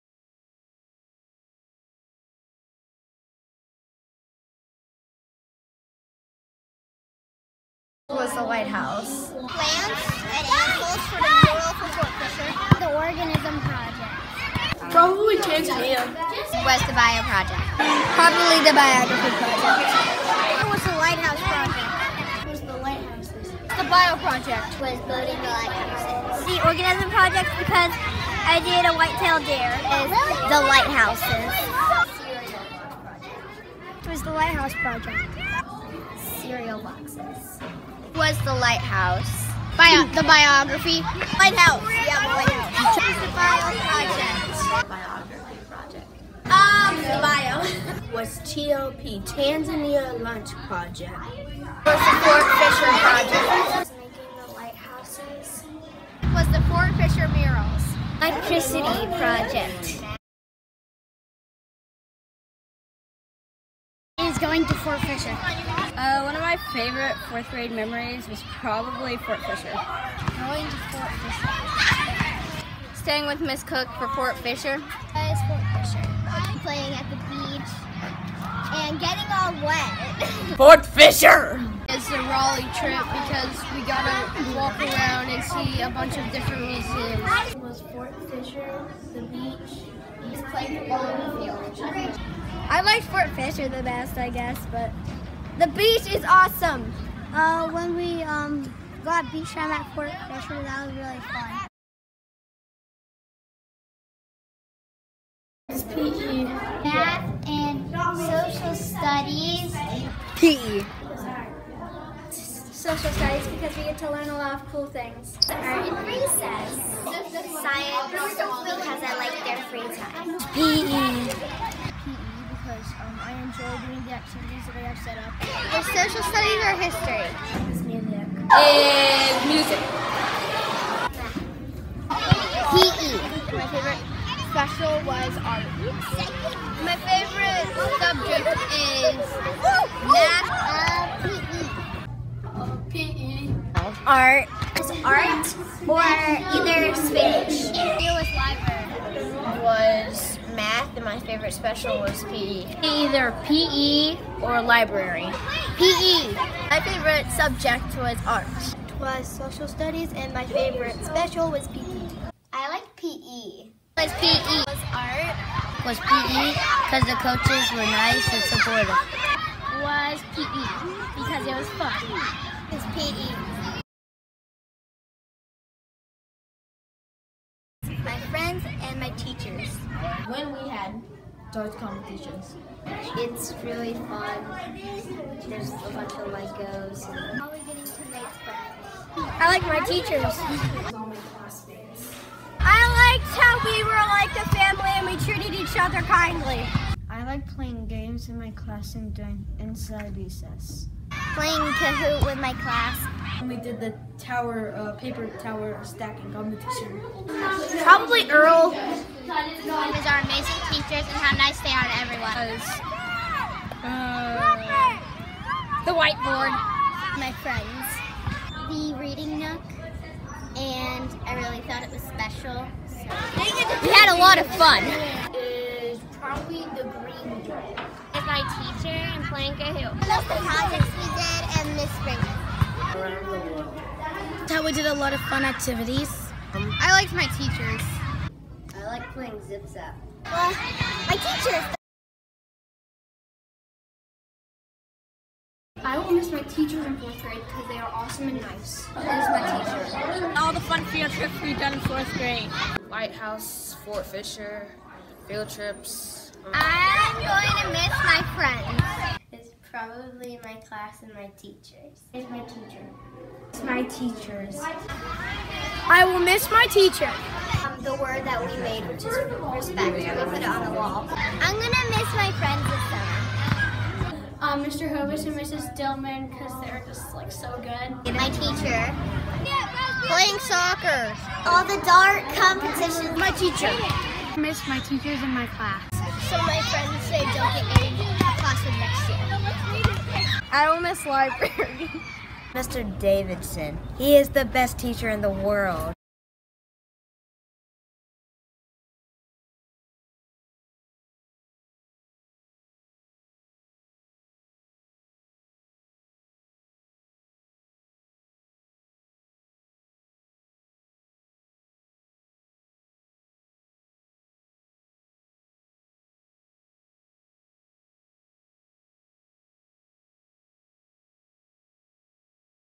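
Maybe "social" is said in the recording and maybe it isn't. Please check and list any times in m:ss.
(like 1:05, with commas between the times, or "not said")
1:48, 1:52, 2:05, 2:39.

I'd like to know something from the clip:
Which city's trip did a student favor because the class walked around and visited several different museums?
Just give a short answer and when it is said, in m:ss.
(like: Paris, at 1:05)
Raleigh, at 1:22.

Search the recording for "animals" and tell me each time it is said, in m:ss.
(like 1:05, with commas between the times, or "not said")
0:10.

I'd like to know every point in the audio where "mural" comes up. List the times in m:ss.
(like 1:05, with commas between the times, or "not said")
0:11, 0:57.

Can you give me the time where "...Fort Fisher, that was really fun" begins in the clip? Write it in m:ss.
1:39.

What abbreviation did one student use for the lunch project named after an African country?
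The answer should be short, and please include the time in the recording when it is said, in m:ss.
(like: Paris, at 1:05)
TLP, at 0:48.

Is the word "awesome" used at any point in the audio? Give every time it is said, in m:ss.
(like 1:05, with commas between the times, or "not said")
1:36, 4:07.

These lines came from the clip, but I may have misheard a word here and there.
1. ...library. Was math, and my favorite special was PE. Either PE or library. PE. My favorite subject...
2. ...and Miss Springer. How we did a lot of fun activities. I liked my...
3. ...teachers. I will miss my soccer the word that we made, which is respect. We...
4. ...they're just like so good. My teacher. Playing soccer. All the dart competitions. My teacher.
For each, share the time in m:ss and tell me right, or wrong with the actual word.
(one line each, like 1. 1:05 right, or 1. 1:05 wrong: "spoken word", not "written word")
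1. 2:28 right
2. 3:51 right
3. 4:23 wrong: "teacher", not "soccer"
4. 4:36 right.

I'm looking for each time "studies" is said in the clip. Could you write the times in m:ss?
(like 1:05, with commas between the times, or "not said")
1:48, 1:53, 2:06, 2:39.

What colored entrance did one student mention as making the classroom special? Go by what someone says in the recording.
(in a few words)
The green door.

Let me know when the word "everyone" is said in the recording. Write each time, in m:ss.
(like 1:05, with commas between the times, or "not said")
3:32.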